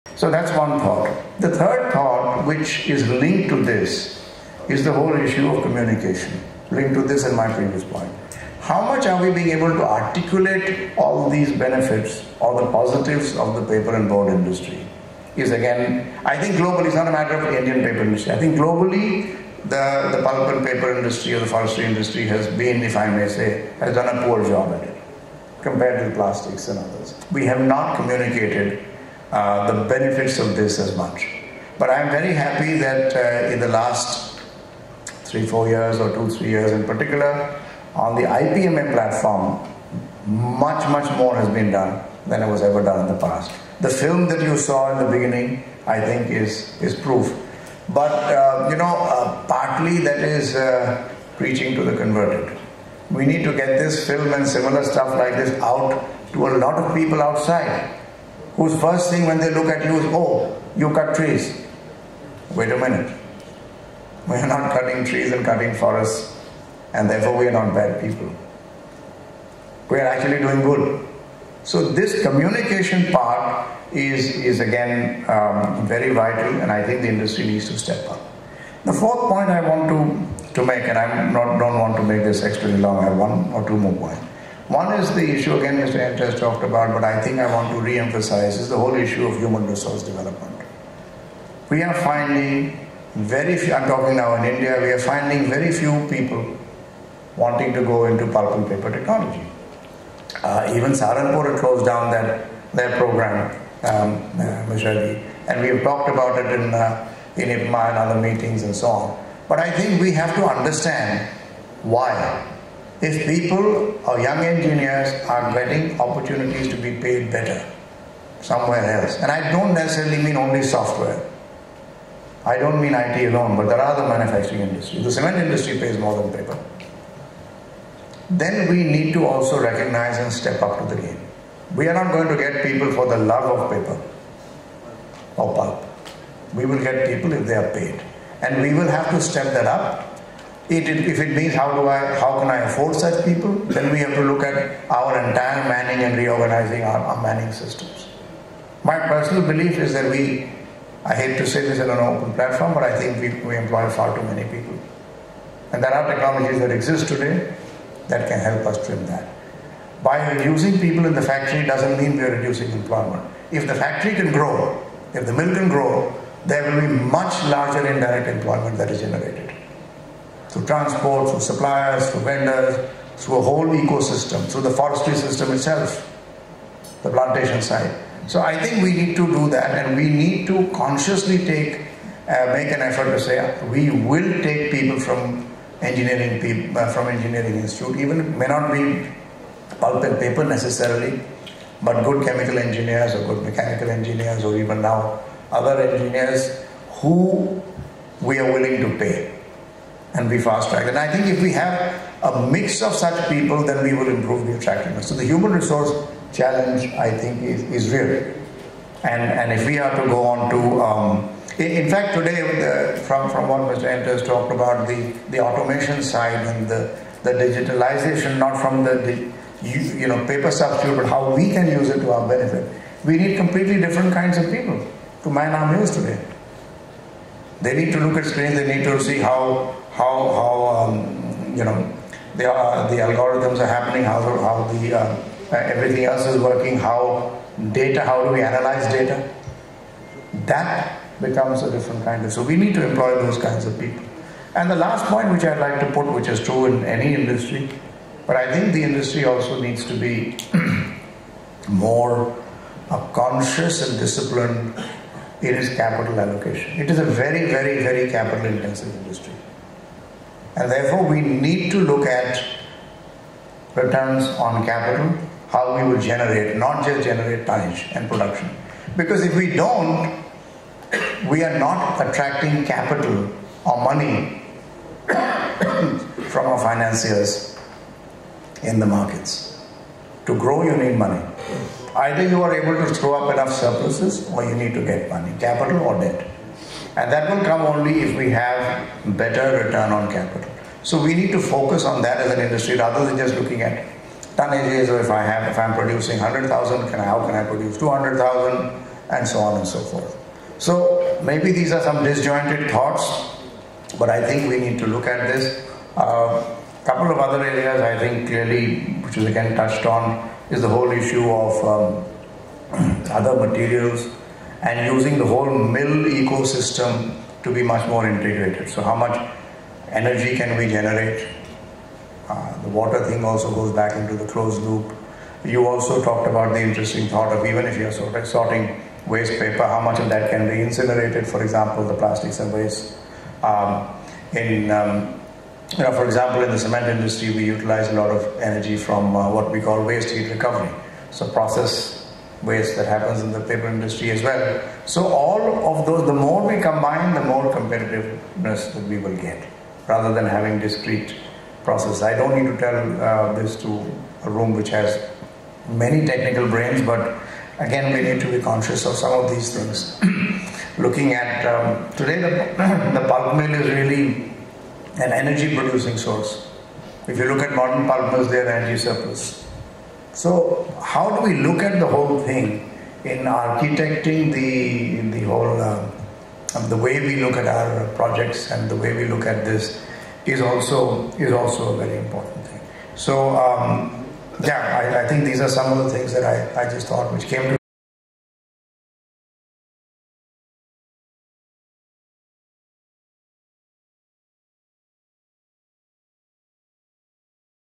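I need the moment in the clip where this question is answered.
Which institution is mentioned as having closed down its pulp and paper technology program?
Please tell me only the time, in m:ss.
1:40.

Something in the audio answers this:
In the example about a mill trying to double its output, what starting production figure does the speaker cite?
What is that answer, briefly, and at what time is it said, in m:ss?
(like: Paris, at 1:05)
100,000, at 4:56.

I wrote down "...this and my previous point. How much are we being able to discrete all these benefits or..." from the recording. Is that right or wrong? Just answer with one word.
wrong.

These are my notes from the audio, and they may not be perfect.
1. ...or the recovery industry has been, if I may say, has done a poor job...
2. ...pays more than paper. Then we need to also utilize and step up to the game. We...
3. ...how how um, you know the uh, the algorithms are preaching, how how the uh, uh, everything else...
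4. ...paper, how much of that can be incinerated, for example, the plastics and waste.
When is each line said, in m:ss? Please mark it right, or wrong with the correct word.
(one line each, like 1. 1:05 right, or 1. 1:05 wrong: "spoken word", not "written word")
1. 0:21 wrong: "forestry", not "recovery"
2. 2:05 wrong: "recognize", not "utilize"
3. 3:50 wrong: "happening", not "preaching"
4. 5:29 right.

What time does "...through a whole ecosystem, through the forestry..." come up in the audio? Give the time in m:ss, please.
2:53.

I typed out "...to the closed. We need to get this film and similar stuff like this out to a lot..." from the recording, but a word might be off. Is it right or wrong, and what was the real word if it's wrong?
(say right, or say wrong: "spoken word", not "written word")
wrong: "converted", not "closed".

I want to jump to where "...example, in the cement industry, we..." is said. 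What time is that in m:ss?
5:36.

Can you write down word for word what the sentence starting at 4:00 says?
That becomes a different kind of.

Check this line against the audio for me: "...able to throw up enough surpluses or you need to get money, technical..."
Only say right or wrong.
wrong.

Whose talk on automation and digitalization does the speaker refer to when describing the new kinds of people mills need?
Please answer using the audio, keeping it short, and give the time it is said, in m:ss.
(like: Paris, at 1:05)
Mr. Enters, at 3:33.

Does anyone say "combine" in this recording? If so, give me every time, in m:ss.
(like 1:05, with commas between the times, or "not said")
5:46.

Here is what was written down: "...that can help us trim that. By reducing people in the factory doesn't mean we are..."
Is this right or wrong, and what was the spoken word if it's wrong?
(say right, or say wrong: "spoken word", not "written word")
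right.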